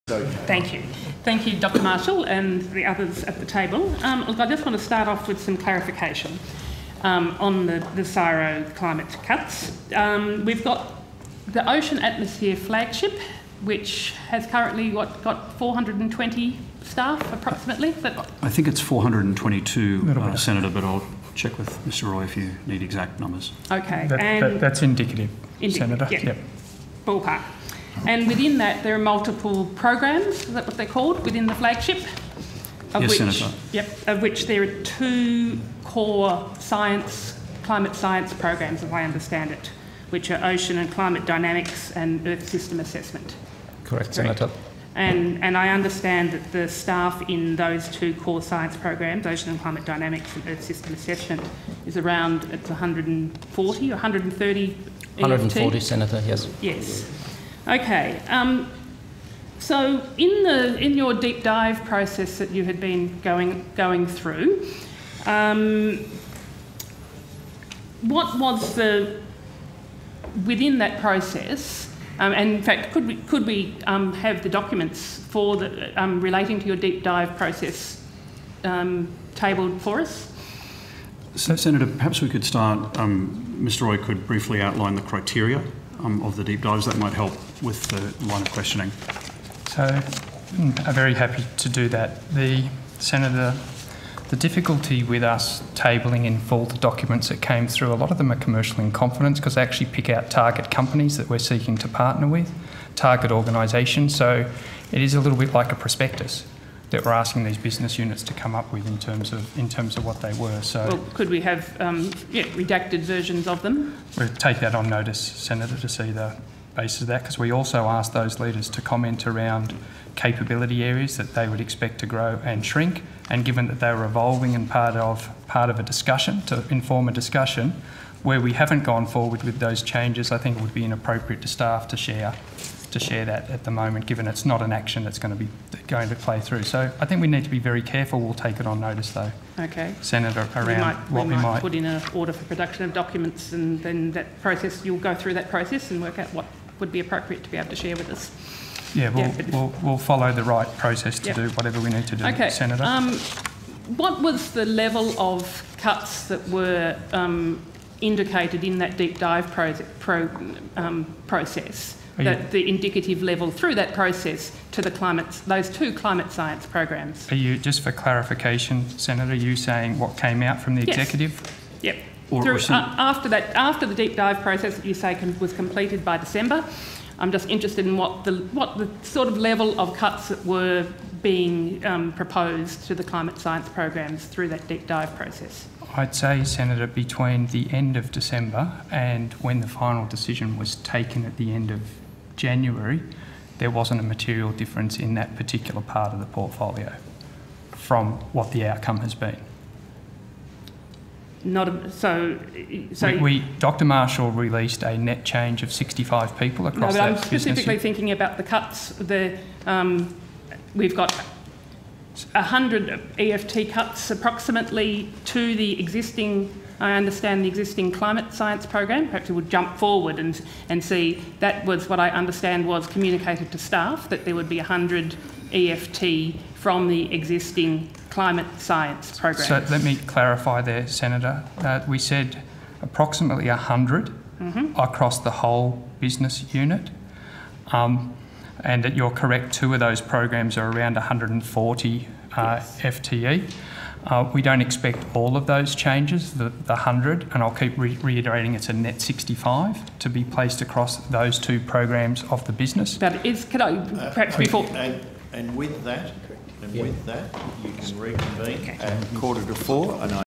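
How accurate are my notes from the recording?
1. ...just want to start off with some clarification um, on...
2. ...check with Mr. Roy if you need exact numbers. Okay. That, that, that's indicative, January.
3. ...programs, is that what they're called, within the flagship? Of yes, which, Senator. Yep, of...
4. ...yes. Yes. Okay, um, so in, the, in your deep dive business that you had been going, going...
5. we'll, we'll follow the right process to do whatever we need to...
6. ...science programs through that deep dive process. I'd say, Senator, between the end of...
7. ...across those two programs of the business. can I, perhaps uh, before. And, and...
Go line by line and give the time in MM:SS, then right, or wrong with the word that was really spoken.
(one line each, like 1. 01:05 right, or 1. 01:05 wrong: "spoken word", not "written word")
1. 00:04 right
2. 00:21 wrong: "Senator", not "January"
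3. 00:29 right
4. 00:56 wrong: "process", not "business"
5. 02:29 right
6. 03:03 right
7. 04:10 right.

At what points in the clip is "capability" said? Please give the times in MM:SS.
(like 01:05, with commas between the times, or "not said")
02:00.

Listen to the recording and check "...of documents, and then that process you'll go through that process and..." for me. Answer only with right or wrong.
right.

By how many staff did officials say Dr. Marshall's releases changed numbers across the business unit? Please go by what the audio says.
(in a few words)
65 people.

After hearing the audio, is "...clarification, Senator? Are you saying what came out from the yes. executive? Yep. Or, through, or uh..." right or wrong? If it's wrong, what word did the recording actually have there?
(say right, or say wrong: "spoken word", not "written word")
right.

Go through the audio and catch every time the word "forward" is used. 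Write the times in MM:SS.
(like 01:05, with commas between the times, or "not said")
02:09, 03:39.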